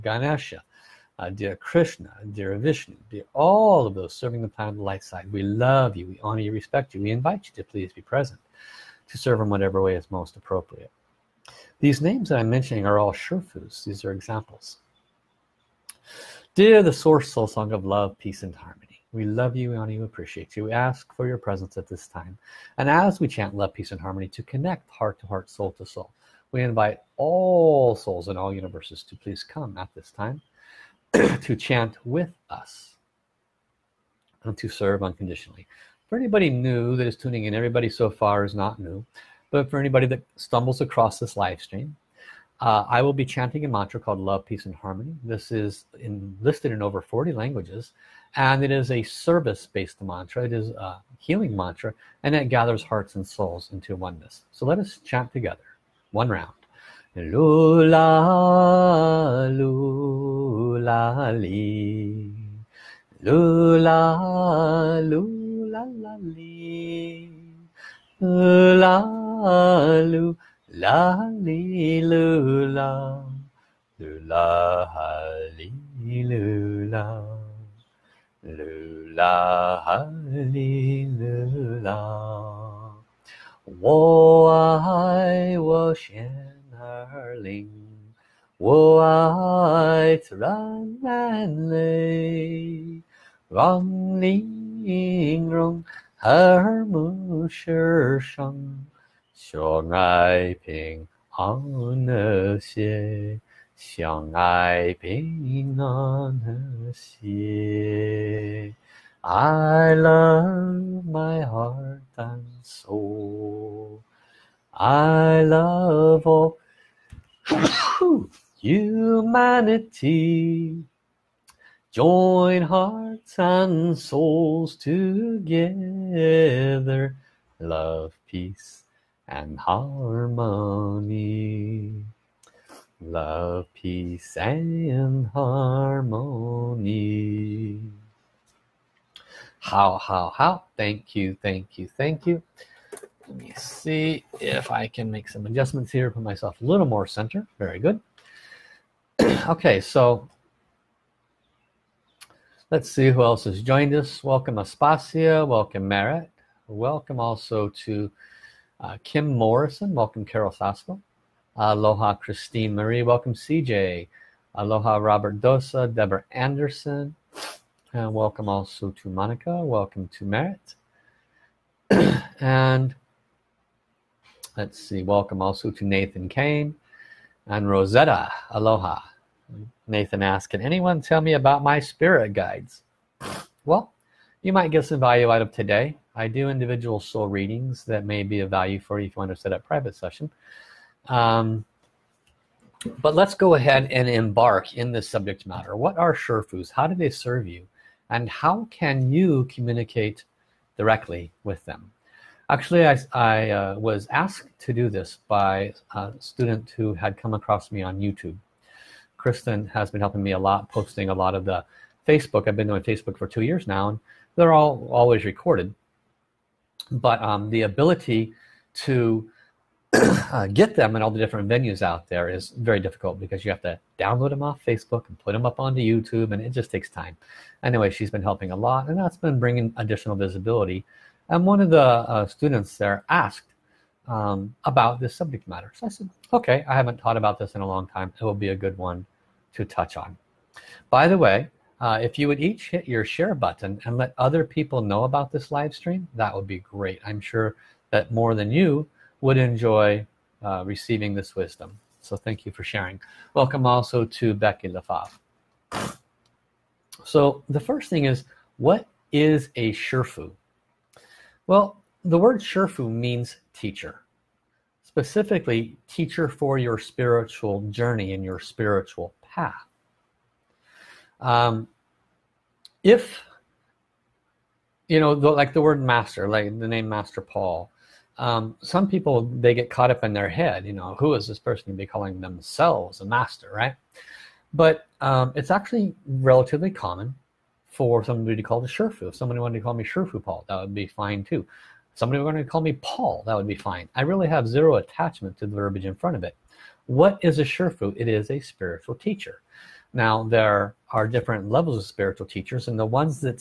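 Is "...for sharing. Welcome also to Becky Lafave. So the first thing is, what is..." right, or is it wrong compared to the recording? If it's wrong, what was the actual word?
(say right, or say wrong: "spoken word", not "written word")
right.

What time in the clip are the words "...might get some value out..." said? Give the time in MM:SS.
03:04.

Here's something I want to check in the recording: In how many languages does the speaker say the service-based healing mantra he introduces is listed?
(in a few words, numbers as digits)
over 40.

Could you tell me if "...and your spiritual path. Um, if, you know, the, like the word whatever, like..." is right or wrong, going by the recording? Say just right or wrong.
wrong.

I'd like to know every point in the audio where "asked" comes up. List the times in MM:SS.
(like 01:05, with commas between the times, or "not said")
03:00, 03:24, 03:53.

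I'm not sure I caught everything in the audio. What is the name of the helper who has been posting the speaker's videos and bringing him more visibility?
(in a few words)
Kristen.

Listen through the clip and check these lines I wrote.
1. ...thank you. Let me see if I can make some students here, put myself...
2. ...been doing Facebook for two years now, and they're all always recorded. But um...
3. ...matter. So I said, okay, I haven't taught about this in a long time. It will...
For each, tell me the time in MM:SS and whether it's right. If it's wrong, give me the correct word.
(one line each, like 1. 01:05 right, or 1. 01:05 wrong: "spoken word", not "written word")
1. 02:21 wrong: "adjustments", not "students"
2. 03:32 right
3. 03:55 right.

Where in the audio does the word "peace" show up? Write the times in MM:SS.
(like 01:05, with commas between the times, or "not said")
00:18, 00:23, 00:44, 02:08, 02:13.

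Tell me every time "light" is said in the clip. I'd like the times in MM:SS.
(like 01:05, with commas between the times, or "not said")
00:04.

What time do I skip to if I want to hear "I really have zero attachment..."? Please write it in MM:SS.
04:53.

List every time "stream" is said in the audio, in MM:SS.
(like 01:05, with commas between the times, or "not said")
00:41, 04:05.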